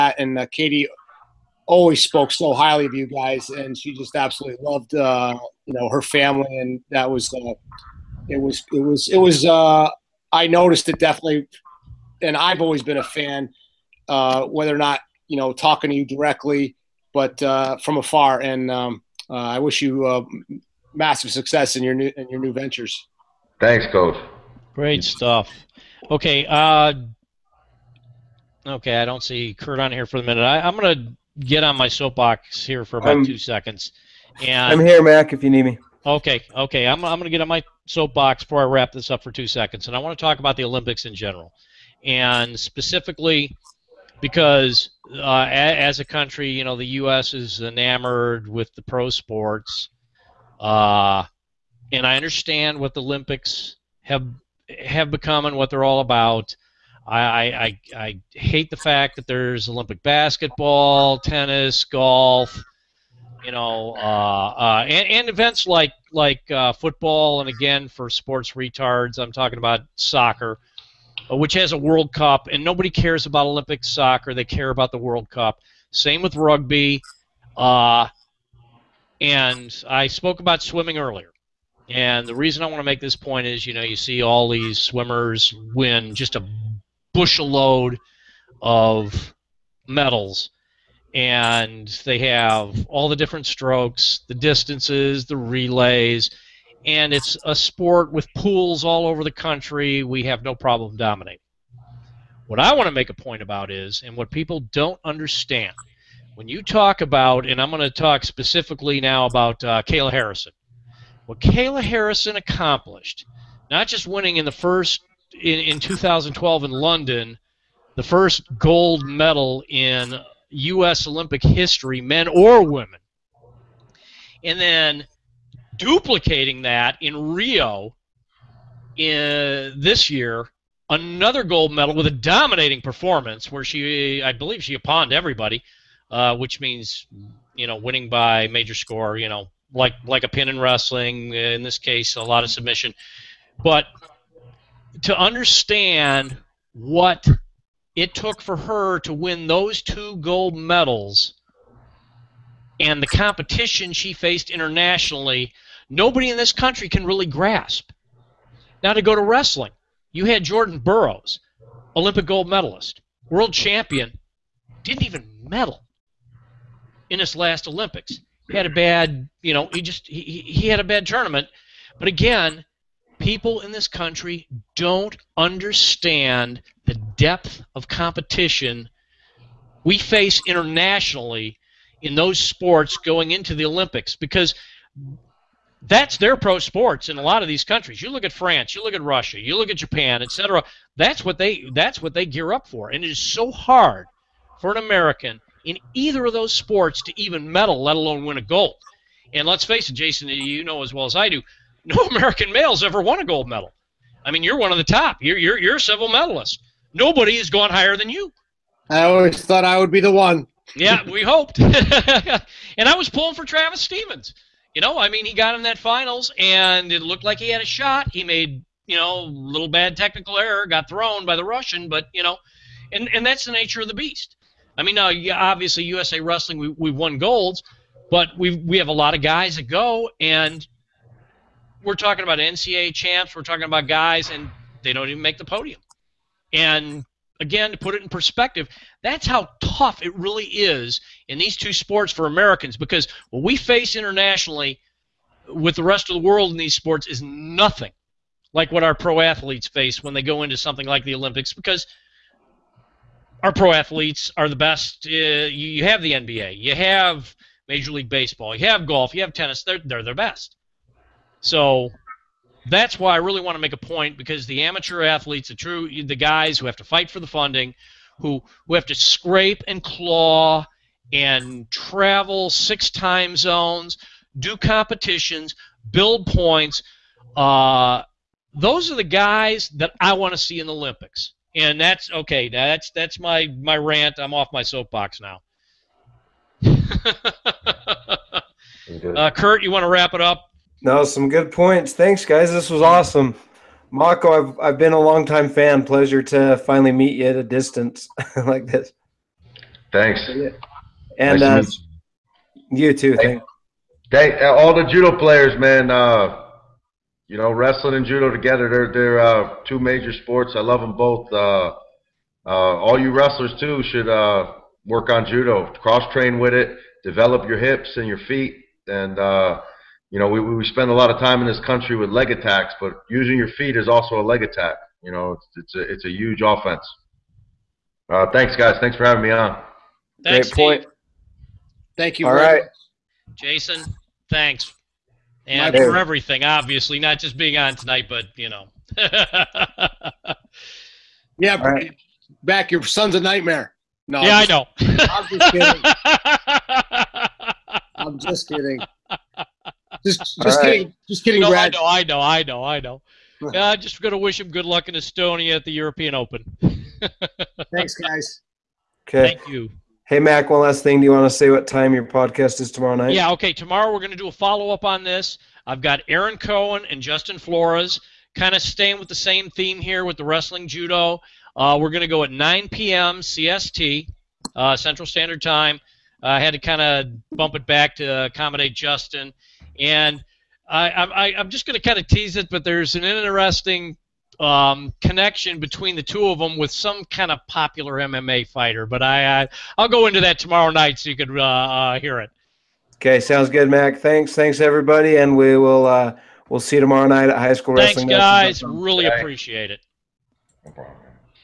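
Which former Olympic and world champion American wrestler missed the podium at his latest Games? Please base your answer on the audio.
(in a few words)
Jordan Burroughs.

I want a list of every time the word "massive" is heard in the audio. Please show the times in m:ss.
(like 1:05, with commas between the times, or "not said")
0:20.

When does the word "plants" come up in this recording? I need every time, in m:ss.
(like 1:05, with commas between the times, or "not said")
not said.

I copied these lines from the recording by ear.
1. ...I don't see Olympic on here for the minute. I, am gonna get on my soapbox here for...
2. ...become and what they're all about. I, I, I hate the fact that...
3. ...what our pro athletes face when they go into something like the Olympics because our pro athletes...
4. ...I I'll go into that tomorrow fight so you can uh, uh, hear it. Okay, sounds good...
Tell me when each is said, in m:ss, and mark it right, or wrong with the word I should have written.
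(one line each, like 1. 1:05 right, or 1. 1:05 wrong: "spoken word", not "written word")
1. 0:28 wrong: "Kurt", not "Olympic"
2. 0:55 right
3. 4:08 right
4. 6:29 wrong: "night", not "fight".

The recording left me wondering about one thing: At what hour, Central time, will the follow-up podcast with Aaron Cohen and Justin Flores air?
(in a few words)
9 p.m.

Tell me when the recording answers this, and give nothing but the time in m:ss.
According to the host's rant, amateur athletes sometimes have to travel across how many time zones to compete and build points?
4:32.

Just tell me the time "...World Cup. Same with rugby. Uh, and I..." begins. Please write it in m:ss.
1:14.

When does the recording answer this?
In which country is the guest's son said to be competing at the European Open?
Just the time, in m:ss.
5:54.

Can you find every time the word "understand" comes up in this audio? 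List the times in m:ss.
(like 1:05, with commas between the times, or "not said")
0:52, 1:45, 2:25, 2:55.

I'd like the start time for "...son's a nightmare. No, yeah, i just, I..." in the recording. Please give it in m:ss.
5:42.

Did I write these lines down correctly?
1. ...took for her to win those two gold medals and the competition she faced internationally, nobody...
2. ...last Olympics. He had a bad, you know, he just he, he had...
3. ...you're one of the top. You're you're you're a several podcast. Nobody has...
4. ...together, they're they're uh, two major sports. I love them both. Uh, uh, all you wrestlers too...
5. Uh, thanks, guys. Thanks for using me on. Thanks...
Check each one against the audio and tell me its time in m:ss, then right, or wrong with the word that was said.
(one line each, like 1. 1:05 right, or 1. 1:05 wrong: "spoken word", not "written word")
1. 2:28 right
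2. 2:47 right
3. 3:24 wrong: "medalist", not "podcast"
4. 5:08 right
5. 5:28 wrong: "having", not "using".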